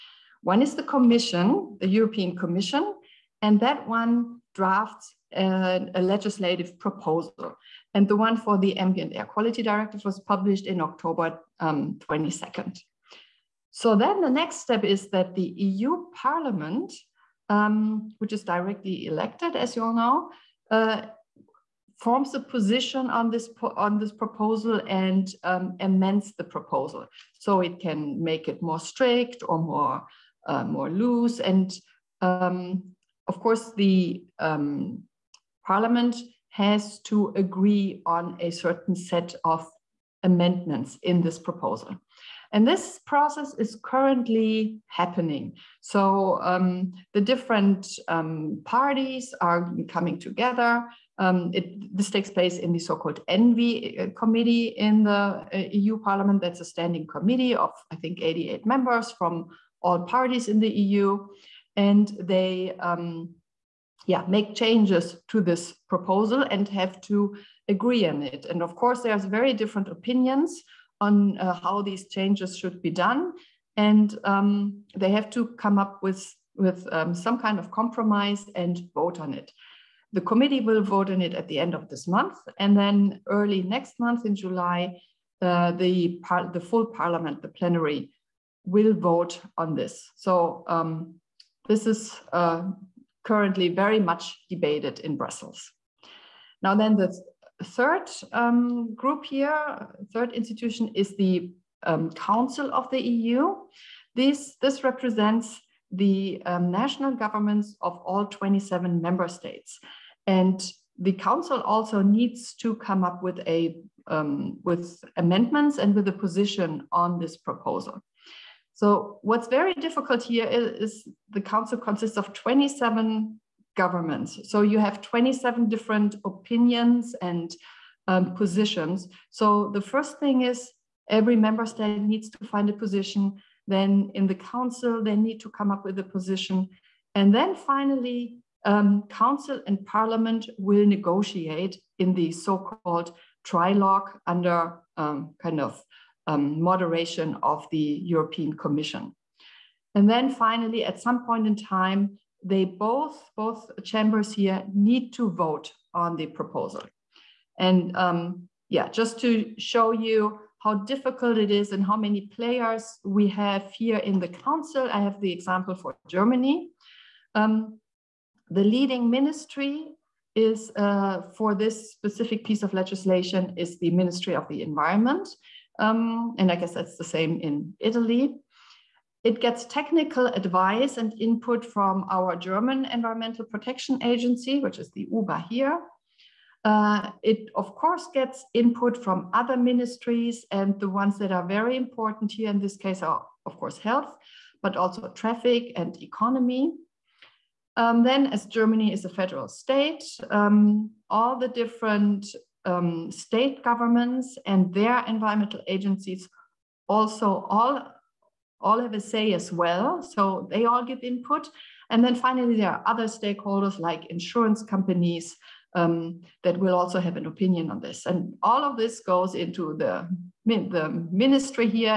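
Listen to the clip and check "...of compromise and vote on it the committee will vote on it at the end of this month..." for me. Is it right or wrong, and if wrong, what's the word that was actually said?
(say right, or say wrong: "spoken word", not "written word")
right.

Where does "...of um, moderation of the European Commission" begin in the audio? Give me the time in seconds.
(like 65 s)
145 s.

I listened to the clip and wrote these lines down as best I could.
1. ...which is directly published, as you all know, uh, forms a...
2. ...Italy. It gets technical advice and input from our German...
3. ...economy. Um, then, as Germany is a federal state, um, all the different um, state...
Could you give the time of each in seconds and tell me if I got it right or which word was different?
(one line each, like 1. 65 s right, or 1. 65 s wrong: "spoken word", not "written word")
1. 18 s wrong: "elected", not "published"
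2. 177 s right
3. 196 s right.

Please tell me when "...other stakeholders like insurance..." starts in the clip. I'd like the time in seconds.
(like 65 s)
212 s.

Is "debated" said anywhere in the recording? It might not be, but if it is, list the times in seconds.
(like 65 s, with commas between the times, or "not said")
94 s.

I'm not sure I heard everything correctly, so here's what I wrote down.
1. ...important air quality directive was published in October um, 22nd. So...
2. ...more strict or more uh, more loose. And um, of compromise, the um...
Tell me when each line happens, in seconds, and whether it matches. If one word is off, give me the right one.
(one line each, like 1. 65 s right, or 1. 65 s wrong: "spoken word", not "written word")
1. 8 s wrong: "ambient", not "important"
2. 28 s wrong: "course", not "compromise".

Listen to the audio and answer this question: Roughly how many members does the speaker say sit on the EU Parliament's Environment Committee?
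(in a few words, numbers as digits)
88.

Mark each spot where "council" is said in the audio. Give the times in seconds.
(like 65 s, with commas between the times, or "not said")
102 s, 111 s, 121 s, 134 s, 139 s, 164 s.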